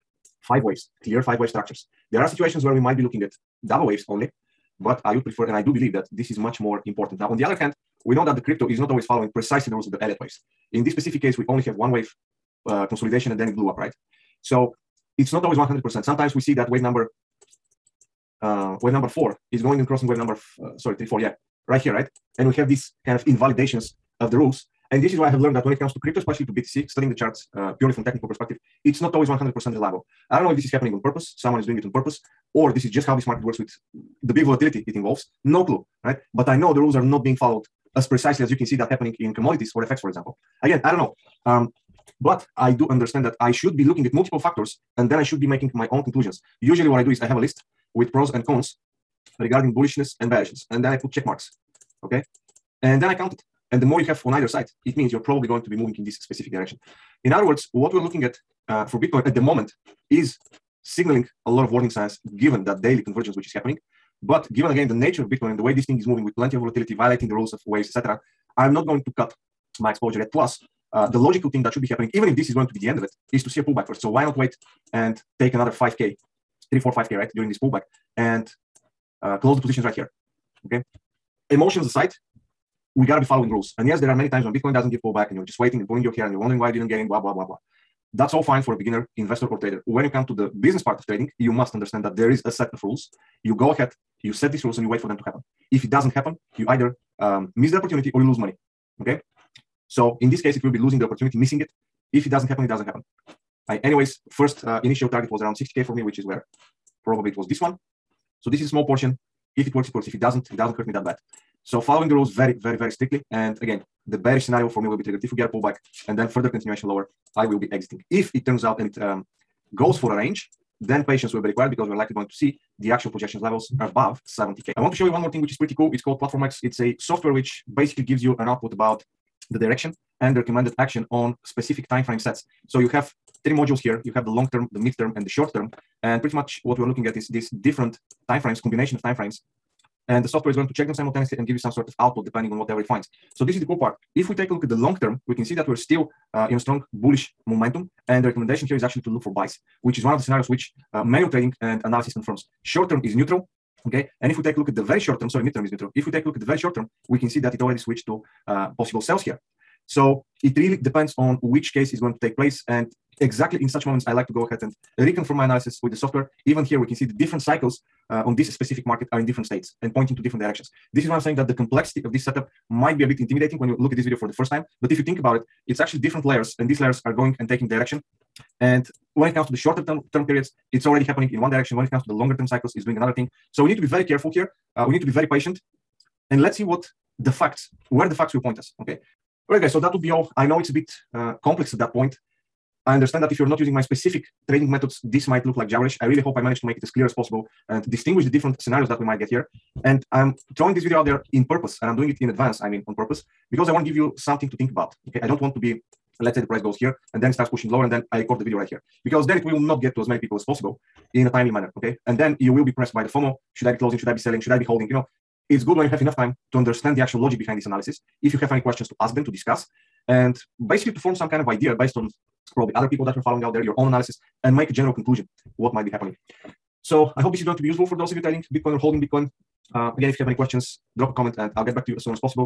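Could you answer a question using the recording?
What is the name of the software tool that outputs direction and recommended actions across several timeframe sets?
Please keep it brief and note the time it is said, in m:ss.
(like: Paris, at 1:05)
PlatformX, at 2:06.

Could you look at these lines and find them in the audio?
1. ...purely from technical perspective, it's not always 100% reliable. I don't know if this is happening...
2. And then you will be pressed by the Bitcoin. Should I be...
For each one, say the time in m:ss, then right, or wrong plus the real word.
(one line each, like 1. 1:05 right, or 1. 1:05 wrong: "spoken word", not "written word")
1. 0:27 right
2. 3:32 wrong: "FOMO", not "Bitcoin".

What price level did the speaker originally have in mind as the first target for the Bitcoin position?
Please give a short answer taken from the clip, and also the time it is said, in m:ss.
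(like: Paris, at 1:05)
60K, at 1:45.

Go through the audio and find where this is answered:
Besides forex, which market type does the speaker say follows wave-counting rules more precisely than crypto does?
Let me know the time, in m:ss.
0:39.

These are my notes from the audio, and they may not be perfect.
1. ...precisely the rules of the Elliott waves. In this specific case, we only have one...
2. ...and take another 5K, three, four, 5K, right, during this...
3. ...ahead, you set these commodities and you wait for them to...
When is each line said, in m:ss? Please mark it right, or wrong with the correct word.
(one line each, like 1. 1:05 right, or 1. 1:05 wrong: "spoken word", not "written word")
1. 0:09 right
2. 1:14 right
3. 1:33 wrong: "rules", not "commodities".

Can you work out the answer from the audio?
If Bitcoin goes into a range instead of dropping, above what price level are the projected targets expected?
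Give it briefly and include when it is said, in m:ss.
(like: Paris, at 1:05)
70K, at 2:04.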